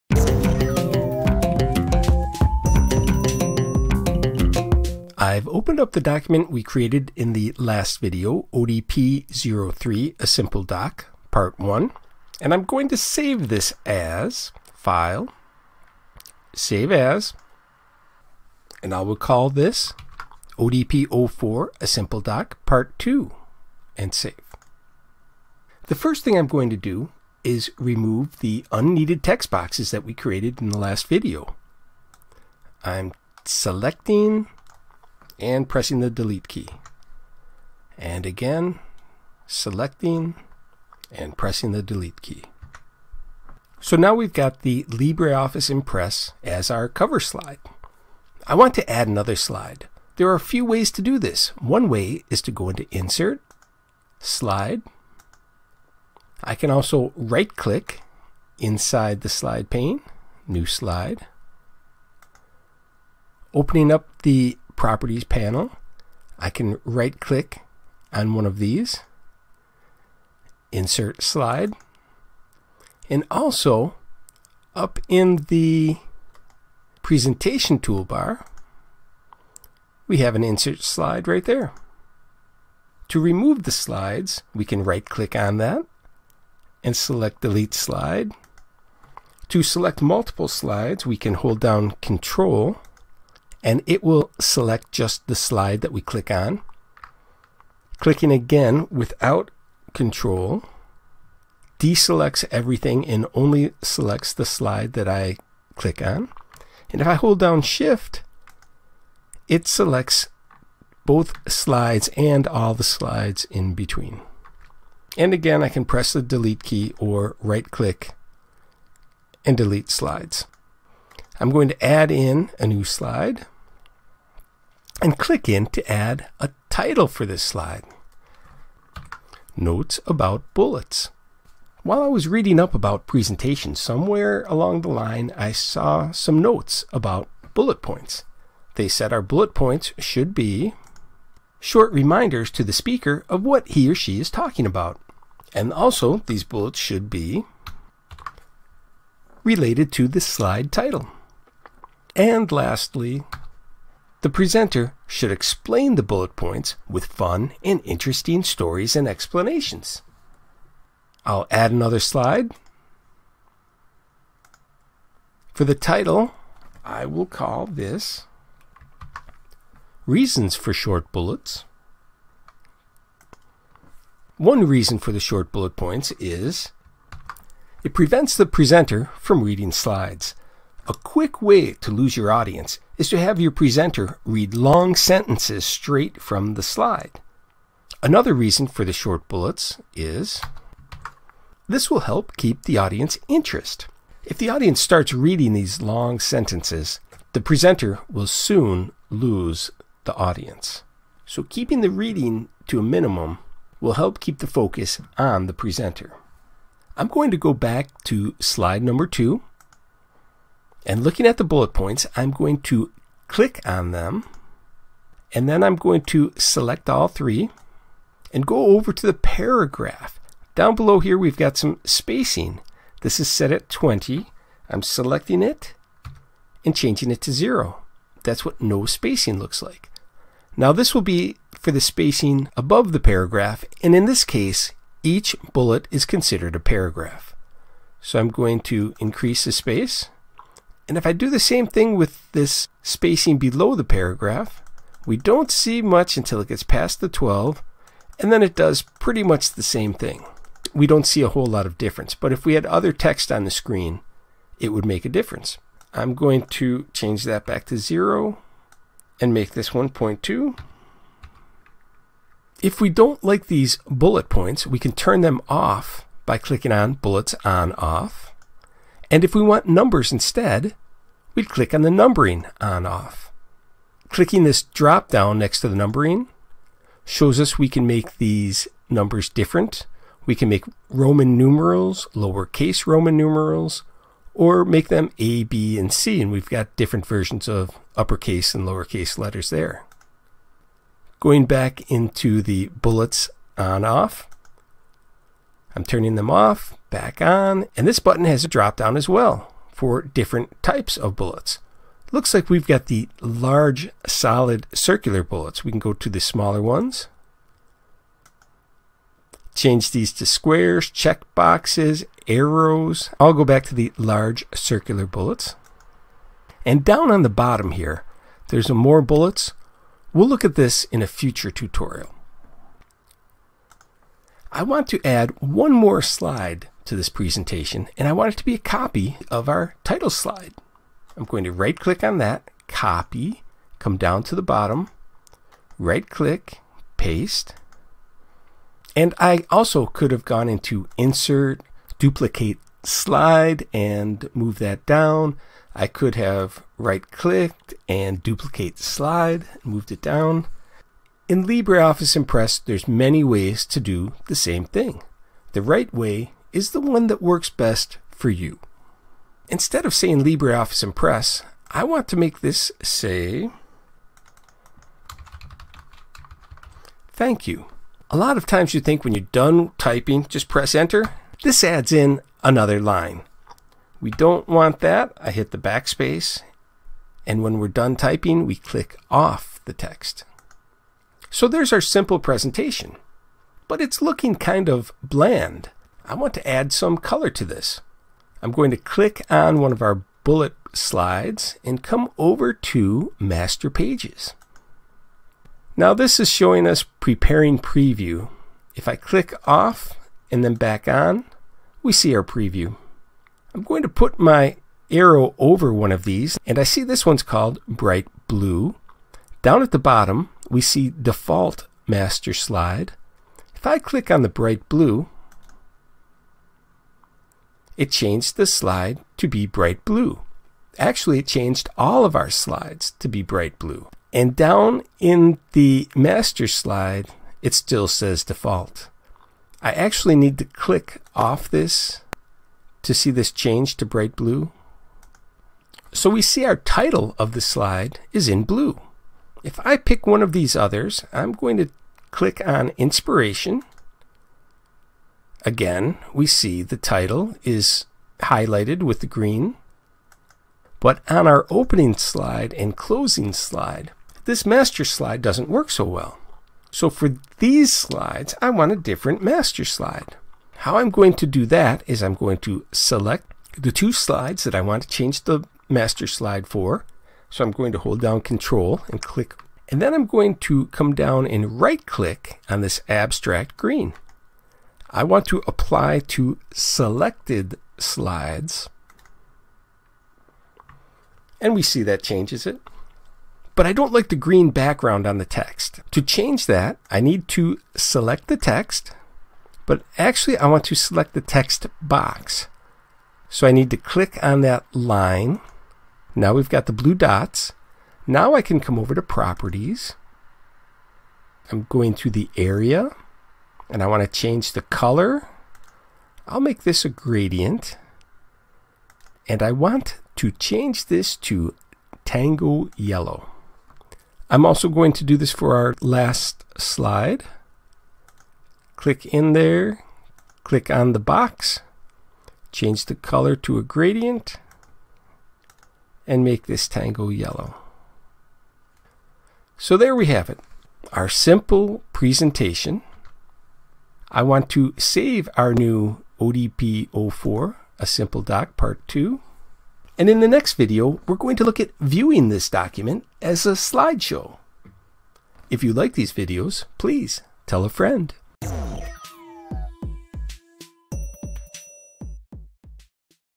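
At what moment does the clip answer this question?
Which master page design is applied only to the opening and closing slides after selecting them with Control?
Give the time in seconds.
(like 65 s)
472 s.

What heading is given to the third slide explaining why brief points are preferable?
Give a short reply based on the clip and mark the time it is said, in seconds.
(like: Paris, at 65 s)
Reasons for Short Bullets, at 170 s.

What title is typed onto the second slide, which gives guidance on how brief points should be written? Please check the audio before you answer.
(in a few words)
Notes about bullets.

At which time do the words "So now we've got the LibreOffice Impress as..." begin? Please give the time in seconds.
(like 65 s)
43 s.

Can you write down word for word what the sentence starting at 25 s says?
The first thing I'm going to do is remove the unneeded text boxes that we created in the last video.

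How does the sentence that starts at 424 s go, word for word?
And down in the master slide, it still says default.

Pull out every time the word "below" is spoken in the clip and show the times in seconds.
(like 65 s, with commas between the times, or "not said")
220 s, 243 s.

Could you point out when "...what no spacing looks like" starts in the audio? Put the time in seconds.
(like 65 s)
228 s.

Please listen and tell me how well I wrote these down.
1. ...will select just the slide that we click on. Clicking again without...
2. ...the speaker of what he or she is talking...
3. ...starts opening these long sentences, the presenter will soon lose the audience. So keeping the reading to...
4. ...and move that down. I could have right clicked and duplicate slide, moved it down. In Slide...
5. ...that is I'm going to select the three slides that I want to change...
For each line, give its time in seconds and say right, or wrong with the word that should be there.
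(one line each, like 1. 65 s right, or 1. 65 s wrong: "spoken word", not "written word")
1. 94 s right
2. 142 s right
3. 194 s wrong: "reading", not "opening"
4. 343 s wrong: "LibreOffice", not "Slide"
5. 461 s wrong: "two", not "three".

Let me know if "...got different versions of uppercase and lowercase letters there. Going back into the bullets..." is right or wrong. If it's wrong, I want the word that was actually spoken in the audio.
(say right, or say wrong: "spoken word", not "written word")
right.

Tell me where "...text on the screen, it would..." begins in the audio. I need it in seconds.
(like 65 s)
252 s.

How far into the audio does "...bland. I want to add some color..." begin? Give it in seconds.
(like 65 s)
385 s.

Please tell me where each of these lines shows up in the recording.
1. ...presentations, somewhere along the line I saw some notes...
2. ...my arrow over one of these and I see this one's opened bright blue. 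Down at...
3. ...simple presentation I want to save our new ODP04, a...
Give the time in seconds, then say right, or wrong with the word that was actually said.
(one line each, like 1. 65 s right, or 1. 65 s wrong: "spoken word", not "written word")
1. 133 s right
2. 404 s wrong: "called", not "opened"
3. 531 s right.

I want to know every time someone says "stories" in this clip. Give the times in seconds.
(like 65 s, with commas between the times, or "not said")
158 s.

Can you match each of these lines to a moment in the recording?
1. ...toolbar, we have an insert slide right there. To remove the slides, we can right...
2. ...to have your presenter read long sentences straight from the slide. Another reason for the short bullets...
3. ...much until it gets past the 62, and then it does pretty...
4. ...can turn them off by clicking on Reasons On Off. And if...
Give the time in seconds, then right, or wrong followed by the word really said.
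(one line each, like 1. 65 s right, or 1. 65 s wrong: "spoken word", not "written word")
1. 77 s right
2. 183 s right
3. 245 s wrong: "12", not "62"
4. 264 s wrong: "Bullets", not "Reasons".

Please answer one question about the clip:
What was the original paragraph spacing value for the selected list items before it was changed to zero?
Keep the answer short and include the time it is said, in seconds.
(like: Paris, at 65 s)
20, at 223 s.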